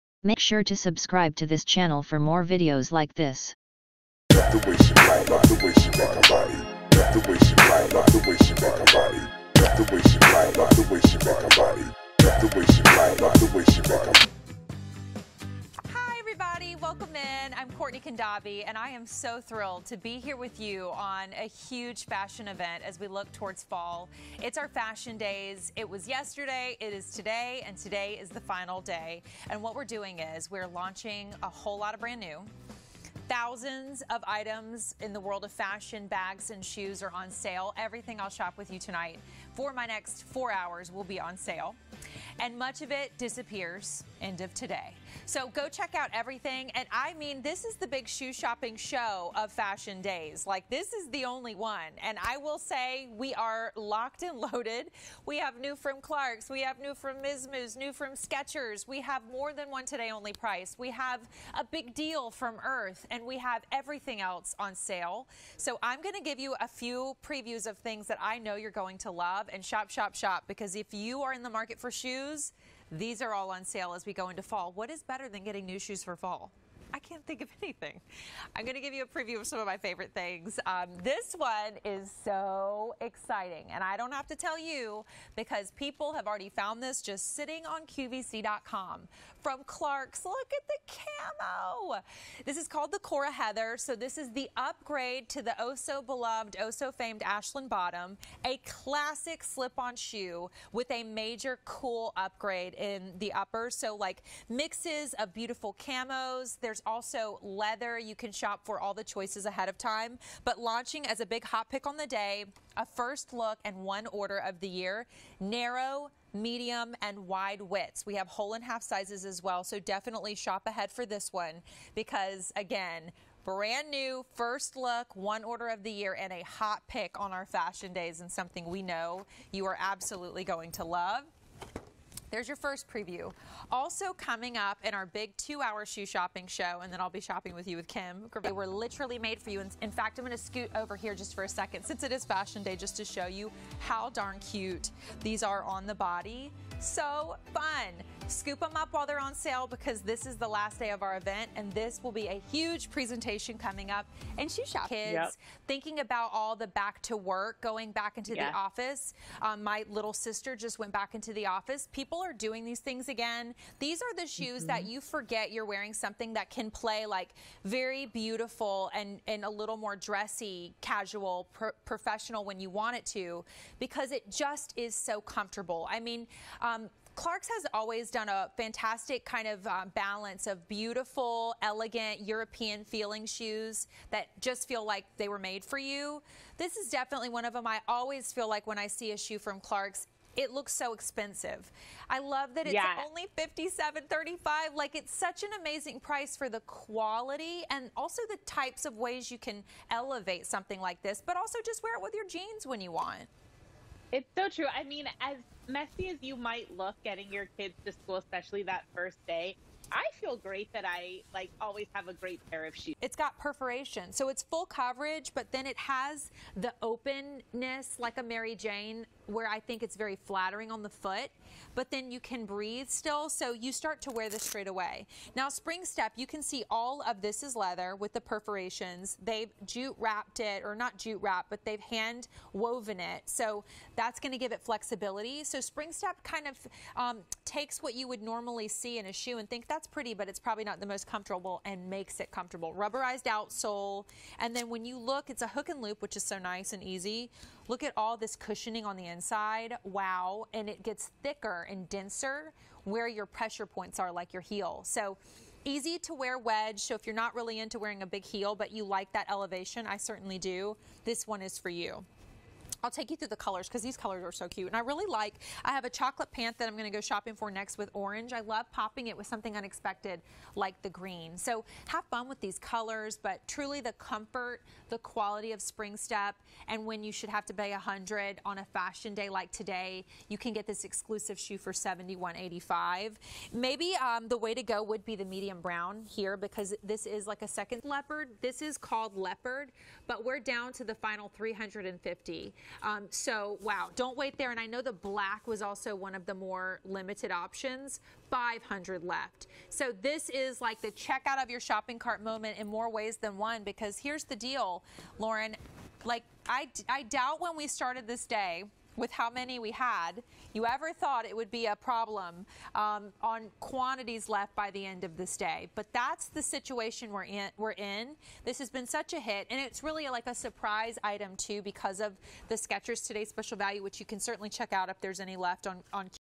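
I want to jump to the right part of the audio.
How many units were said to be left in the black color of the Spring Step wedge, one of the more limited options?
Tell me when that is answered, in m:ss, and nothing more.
4:58.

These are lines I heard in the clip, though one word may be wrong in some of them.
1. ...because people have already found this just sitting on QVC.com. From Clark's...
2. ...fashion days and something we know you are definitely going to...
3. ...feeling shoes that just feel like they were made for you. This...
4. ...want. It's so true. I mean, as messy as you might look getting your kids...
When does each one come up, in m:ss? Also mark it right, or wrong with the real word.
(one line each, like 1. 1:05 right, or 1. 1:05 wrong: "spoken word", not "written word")
1. 1:25 right
2. 2:07 wrong: "absolutely", not "definitely"
3. 3:02 right
4. 3:22 right.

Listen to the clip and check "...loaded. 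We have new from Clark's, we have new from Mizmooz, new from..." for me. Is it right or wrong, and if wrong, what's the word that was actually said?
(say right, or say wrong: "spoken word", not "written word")
right.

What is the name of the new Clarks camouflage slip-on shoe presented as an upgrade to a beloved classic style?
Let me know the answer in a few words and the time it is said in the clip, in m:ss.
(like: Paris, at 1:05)
Cora Heather, at 1:32.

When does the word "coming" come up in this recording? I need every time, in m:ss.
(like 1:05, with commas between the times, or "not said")
2:14, 2:33.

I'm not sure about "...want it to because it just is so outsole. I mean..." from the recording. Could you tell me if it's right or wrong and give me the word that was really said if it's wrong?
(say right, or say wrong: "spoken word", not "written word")
wrong: "comfortable", not "outsole".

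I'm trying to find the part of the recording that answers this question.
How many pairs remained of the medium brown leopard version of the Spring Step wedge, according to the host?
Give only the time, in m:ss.
4:51.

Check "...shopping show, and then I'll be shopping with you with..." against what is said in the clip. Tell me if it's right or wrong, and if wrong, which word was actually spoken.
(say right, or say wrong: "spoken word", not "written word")
right.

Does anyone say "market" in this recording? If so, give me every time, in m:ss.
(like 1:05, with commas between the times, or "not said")
1:11.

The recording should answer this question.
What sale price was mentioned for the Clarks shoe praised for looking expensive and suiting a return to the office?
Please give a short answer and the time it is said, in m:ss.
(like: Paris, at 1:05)
$57.35, at 3:13.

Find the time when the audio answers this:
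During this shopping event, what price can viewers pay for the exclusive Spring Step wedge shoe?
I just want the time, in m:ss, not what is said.
4:41.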